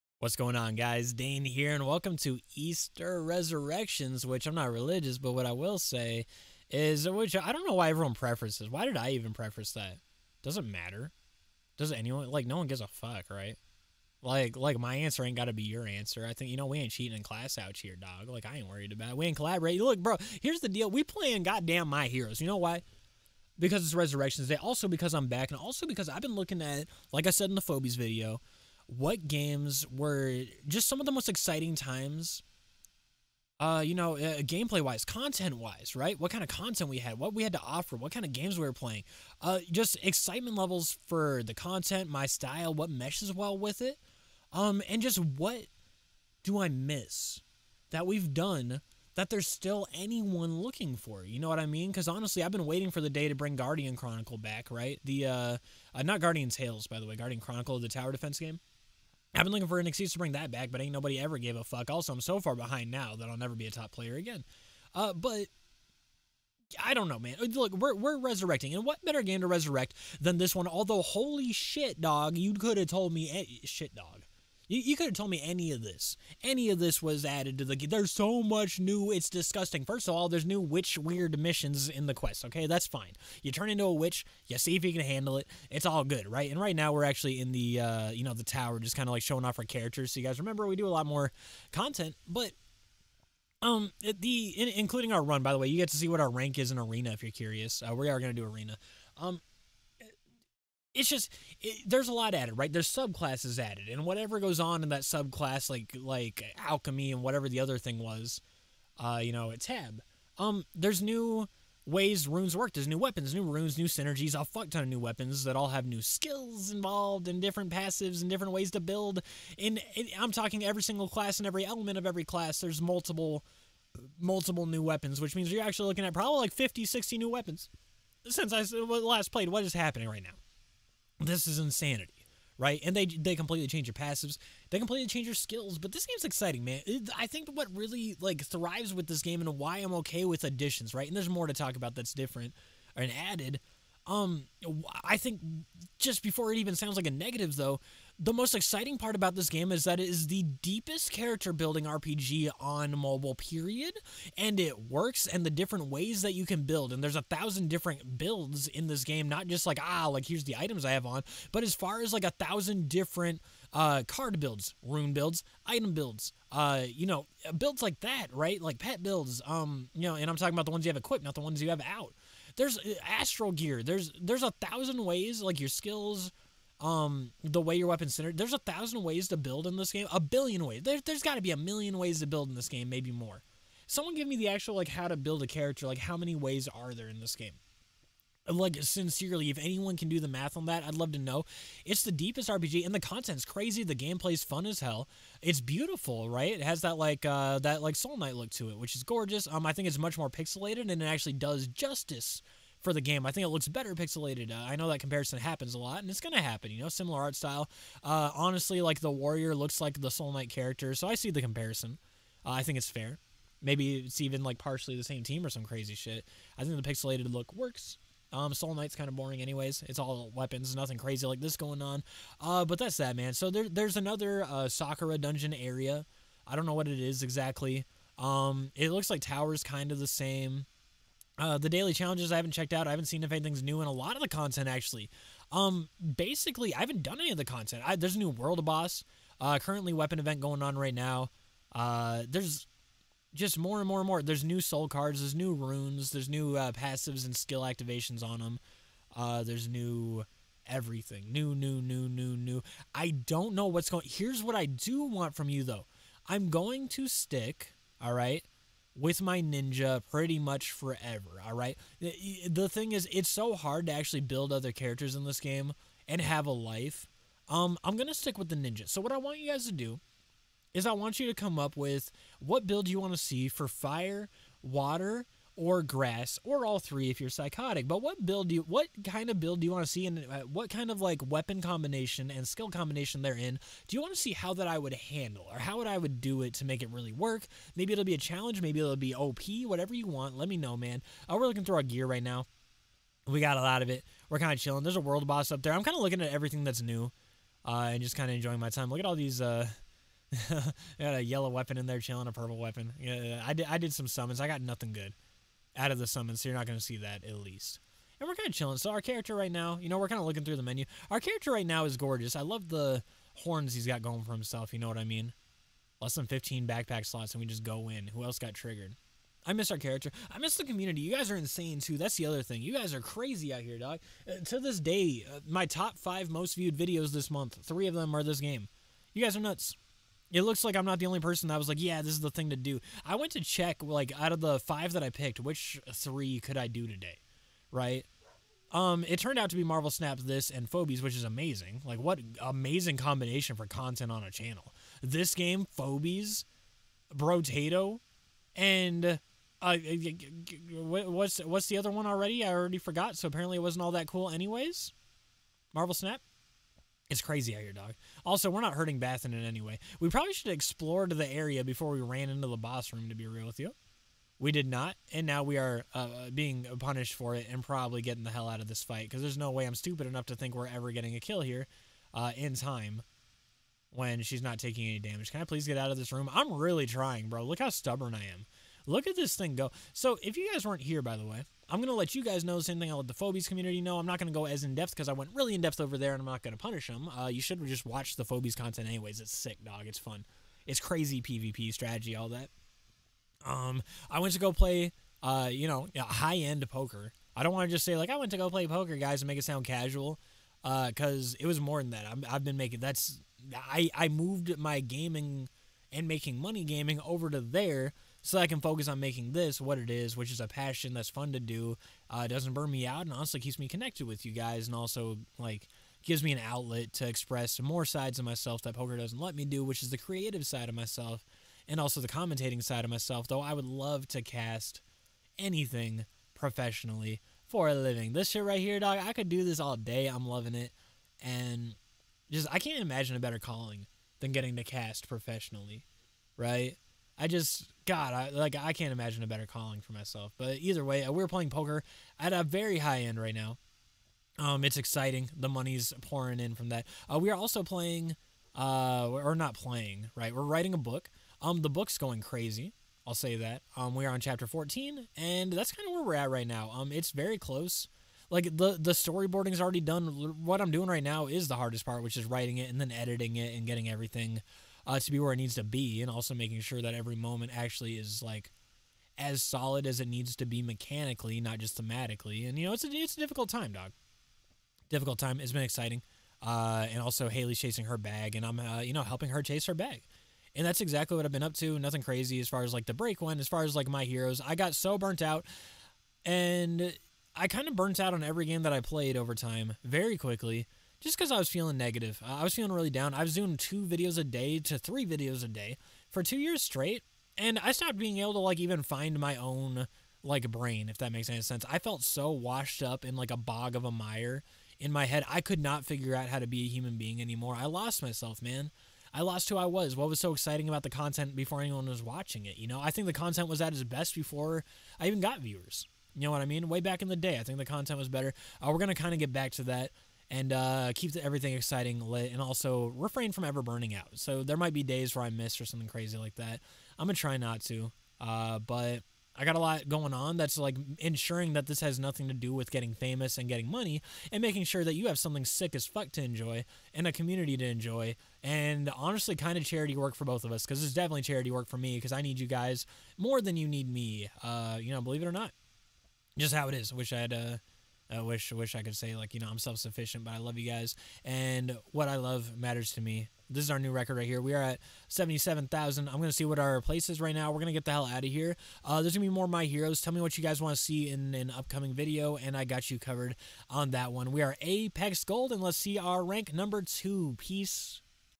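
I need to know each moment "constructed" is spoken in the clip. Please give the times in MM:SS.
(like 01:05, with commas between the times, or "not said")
not said.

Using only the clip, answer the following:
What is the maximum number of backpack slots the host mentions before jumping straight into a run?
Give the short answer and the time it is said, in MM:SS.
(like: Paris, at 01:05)
15, at 05:16.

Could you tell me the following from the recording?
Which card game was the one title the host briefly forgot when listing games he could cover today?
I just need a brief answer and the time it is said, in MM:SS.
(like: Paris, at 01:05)
Marvel Snap, at 05:55.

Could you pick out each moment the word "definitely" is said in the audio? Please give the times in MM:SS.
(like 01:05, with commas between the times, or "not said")
09:00.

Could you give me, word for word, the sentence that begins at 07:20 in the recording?
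But either way, uh, we're playing poker at a very high end right now.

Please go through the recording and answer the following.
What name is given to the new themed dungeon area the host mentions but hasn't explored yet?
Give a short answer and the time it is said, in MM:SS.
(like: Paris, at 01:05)
Sakura, at 03:44.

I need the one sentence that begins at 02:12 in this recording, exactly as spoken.
And they they completely change your passives, they completely change your skills.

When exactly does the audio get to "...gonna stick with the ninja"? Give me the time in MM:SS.
04:27.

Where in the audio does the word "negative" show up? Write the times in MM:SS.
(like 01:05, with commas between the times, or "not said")
02:27, 08:11.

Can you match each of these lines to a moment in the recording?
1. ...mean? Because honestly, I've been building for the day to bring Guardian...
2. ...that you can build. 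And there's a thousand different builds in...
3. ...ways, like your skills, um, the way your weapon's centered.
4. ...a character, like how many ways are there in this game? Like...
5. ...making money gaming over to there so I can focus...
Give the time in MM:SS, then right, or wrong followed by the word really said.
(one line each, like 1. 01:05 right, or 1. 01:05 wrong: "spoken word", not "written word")
1. 00:51 wrong: "waiting", not "building"
2. 02:36 right
3. 02:55 right
4. 03:05 right
5. 06:46 right.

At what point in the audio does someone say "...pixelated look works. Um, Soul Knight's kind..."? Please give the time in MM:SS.
03:36.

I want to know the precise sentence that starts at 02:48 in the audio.
Like pet builds, um, you know, and I'm talking about the ones you have equipped, not the ones you have out.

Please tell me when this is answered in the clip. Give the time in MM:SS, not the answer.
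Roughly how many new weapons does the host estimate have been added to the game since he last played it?
02:06.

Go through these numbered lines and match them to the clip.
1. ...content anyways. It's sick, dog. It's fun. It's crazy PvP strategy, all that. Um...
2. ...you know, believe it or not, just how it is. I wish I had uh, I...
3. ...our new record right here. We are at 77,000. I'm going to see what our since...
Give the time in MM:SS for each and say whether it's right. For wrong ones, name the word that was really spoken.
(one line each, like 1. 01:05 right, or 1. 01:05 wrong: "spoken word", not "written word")
1. 06:28 right
2. 09:04 right
3. 09:13 wrong: "place", not "since".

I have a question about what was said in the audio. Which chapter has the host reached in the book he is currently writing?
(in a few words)
14.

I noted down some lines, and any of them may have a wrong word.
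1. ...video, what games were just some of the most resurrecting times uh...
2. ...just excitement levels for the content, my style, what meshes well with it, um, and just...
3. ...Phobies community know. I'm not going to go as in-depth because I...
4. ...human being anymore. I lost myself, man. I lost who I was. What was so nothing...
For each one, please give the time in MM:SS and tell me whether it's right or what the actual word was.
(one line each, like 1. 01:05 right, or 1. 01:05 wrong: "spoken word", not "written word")
1. 00:27 wrong: "exciting", not "resurrecting"
2. 00:39 right
3. 06:23 right
4. 08:26 wrong: "exciting", not "nothing".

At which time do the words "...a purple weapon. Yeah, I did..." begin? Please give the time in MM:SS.
05:02.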